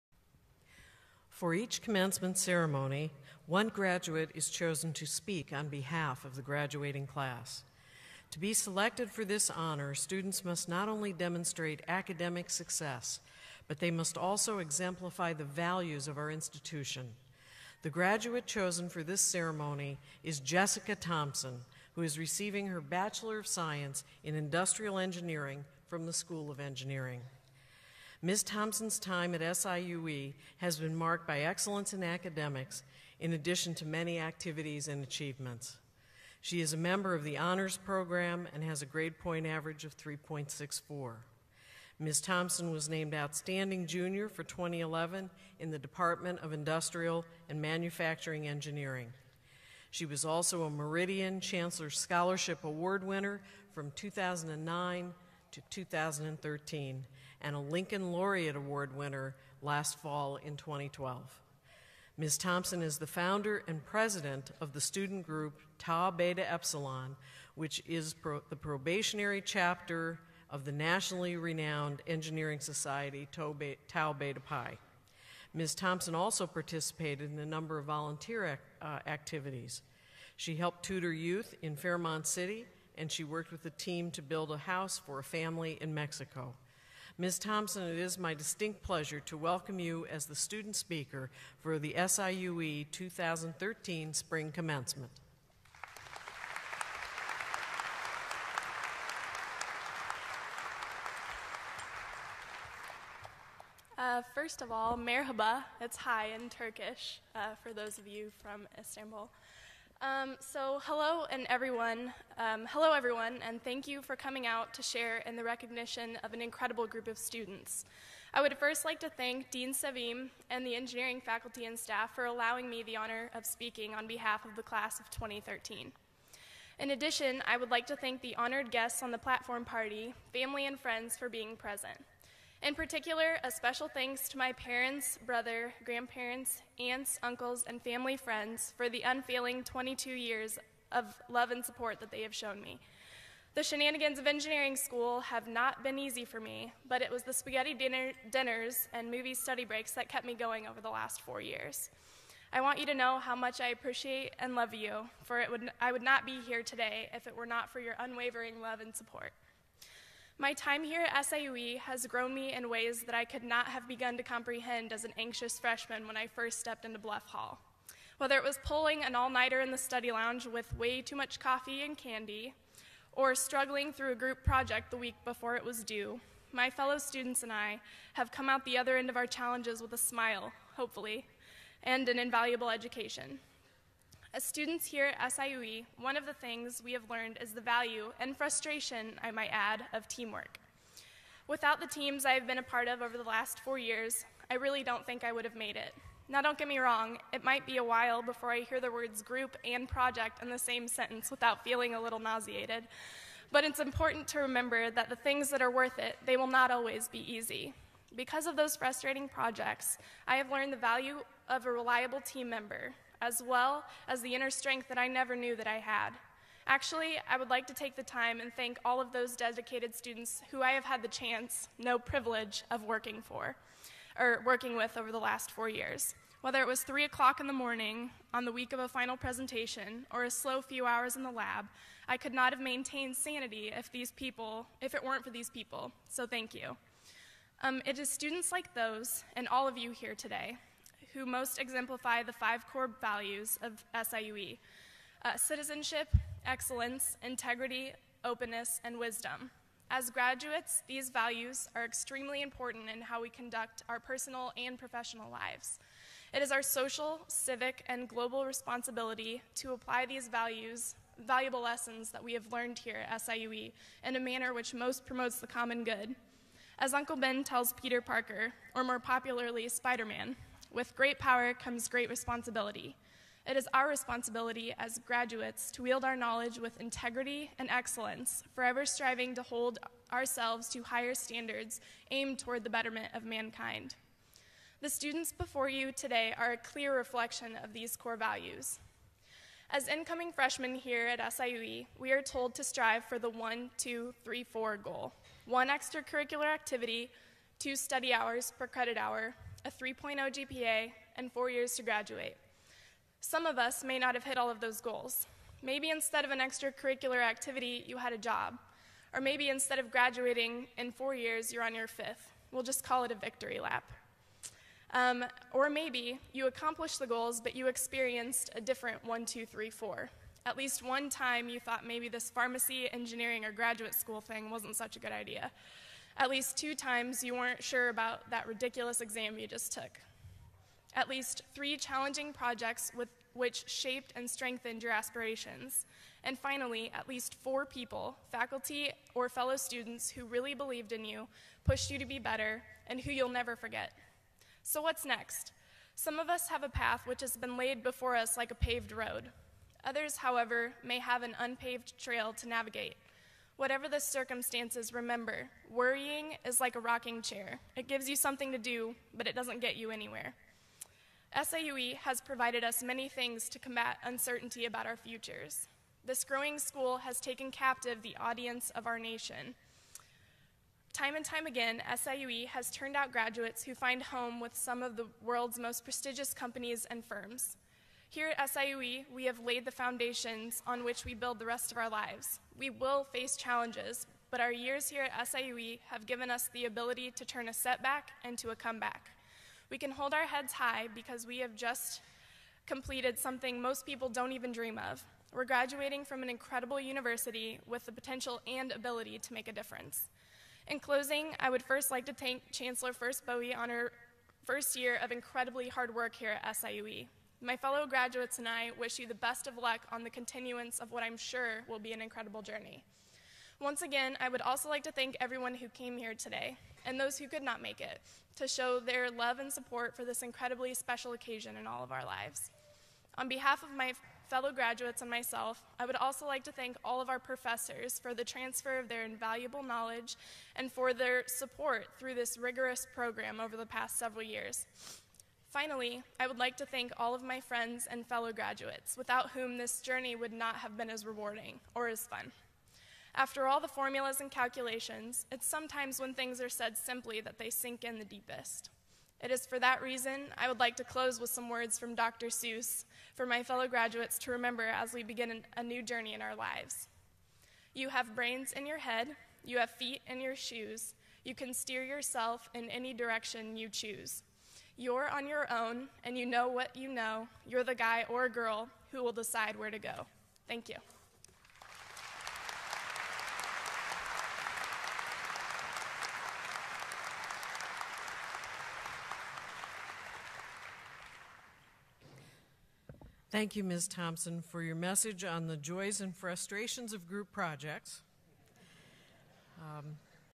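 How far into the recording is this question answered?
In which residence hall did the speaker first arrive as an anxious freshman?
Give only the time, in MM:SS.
02:46.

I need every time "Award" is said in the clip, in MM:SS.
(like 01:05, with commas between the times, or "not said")
00:52, 00:58.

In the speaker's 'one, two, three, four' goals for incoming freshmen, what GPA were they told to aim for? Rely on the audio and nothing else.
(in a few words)
3.0.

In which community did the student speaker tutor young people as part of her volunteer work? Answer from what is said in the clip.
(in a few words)
Fairmont City.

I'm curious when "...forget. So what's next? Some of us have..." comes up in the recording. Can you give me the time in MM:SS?
05:43.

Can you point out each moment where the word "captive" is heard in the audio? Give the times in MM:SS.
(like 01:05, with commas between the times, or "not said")
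06:07.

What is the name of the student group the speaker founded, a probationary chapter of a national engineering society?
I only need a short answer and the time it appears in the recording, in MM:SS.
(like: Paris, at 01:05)
Tau Beta Epsilon, at 01:05.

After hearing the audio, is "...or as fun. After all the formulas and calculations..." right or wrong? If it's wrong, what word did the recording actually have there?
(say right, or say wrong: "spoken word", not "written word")
right.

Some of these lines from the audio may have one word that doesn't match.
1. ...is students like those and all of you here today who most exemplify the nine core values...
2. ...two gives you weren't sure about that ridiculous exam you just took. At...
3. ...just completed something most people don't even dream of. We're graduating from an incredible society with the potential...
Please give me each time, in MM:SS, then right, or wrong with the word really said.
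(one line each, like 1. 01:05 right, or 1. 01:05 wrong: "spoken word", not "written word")
1. 03:57 wrong: "five", not "nine"
2. 05:26 wrong: "times", not "gives"
3. 06:31 wrong: "university", not "society".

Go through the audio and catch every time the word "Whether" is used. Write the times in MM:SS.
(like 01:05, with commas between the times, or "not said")
02:48, 03:46.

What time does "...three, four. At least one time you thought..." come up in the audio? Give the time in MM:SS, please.
05:19.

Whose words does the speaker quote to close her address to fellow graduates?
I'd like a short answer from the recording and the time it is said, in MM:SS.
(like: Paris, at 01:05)
Dr. Seuss, at 07:31.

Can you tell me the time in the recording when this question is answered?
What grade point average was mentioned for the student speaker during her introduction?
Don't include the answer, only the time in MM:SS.
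00:39.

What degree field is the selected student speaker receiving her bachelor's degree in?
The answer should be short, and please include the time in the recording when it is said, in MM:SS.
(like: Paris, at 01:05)
Industrial Engineering, at 00:24.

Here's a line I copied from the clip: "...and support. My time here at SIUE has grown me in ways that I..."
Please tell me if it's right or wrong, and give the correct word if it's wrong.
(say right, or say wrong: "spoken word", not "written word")
right.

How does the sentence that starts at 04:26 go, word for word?
As Uncle Ben tells Peter Parker, or more popularly, Spider Man, with great power comes great responsibility.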